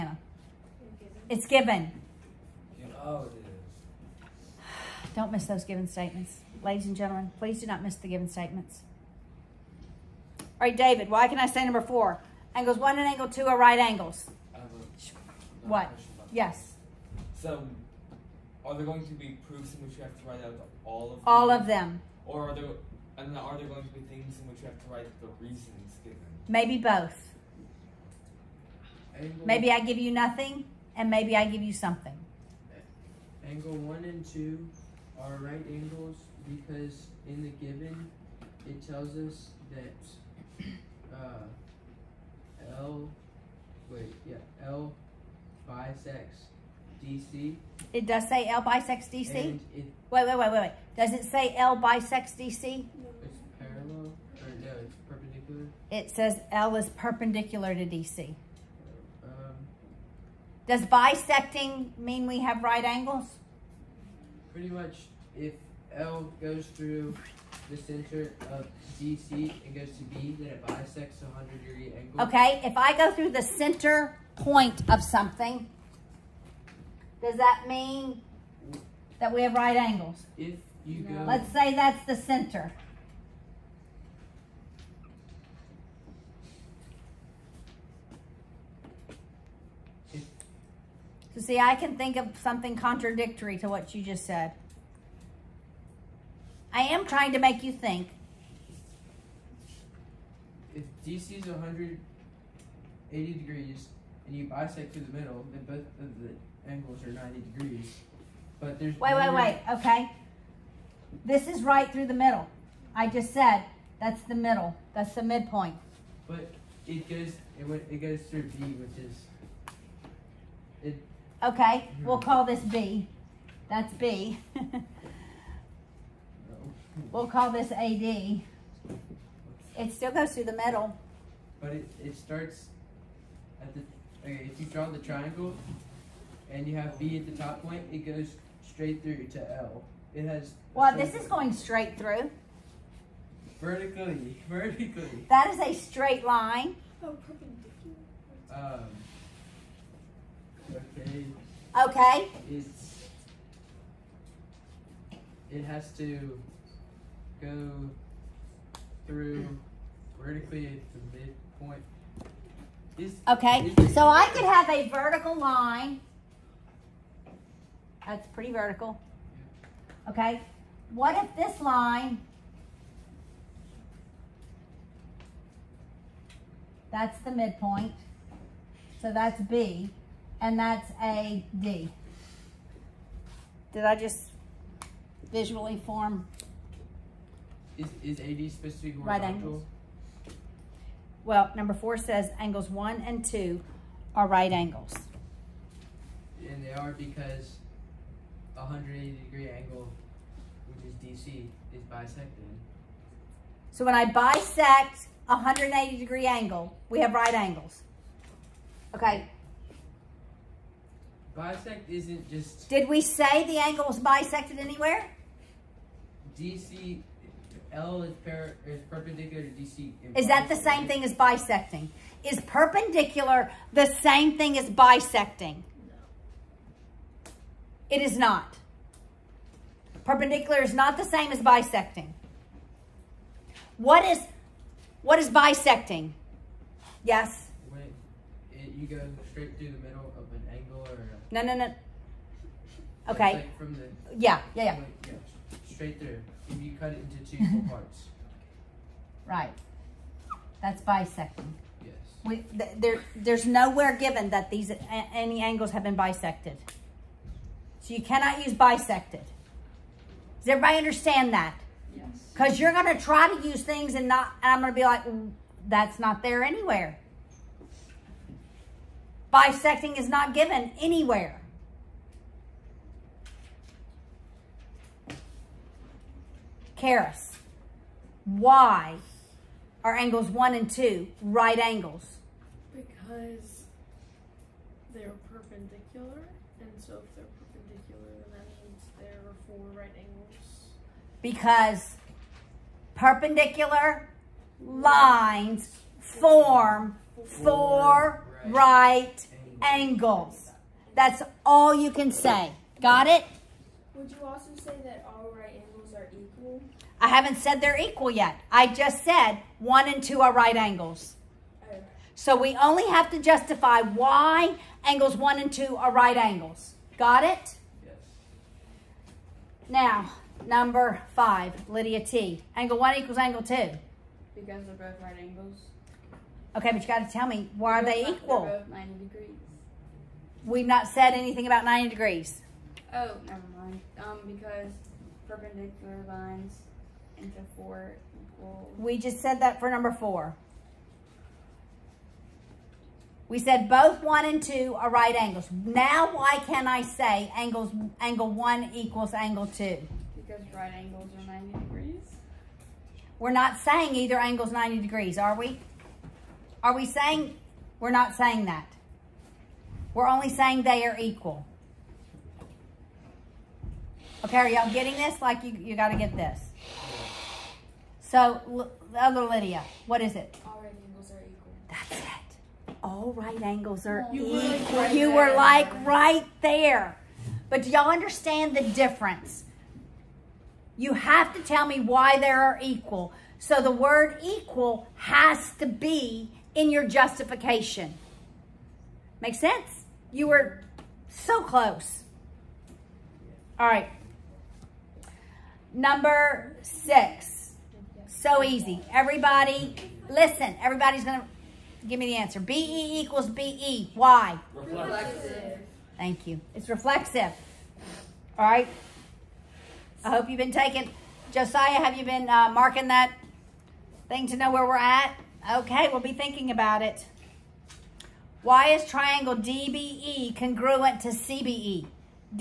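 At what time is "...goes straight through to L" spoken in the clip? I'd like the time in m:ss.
2:18.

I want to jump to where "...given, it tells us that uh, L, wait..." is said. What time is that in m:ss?
0:37.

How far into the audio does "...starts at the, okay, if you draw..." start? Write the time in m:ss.
2:12.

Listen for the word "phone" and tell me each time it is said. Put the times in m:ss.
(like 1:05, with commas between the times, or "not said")
not said.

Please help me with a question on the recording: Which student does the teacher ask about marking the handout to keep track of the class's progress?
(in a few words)
Josiah.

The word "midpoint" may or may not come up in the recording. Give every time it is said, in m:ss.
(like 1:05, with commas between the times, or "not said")
1:55, 2:41, 2:57.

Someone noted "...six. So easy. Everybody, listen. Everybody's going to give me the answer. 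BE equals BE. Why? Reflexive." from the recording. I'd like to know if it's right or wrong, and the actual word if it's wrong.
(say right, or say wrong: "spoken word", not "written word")
right.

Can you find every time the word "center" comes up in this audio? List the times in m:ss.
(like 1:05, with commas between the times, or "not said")
1:07, 1:13, 1:22.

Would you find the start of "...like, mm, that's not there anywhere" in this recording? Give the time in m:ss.
4:24.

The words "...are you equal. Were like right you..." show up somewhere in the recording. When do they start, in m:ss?
6:13.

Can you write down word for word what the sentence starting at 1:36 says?
I am trying to make you think.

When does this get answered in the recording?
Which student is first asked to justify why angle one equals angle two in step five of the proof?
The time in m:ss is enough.
5:21.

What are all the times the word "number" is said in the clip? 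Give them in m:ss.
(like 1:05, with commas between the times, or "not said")
0:11, 3:11, 5:20, 5:39, 6:35.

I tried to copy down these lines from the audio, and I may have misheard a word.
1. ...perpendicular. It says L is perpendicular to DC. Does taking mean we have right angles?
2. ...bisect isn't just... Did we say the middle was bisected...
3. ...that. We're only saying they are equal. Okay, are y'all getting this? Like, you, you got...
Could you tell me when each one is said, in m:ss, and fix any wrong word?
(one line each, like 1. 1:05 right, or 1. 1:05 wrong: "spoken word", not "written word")
1. 0:55 wrong: "bisecting", not "taking"
2. 3:31 wrong: "angle", not "middle"
3. 5:58 right.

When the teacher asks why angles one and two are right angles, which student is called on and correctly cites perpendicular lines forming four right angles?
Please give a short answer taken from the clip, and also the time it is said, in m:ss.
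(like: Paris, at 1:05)
Karis, at 4:36.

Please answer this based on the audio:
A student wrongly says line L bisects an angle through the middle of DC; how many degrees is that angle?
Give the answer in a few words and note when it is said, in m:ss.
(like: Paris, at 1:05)
100, at 1:11.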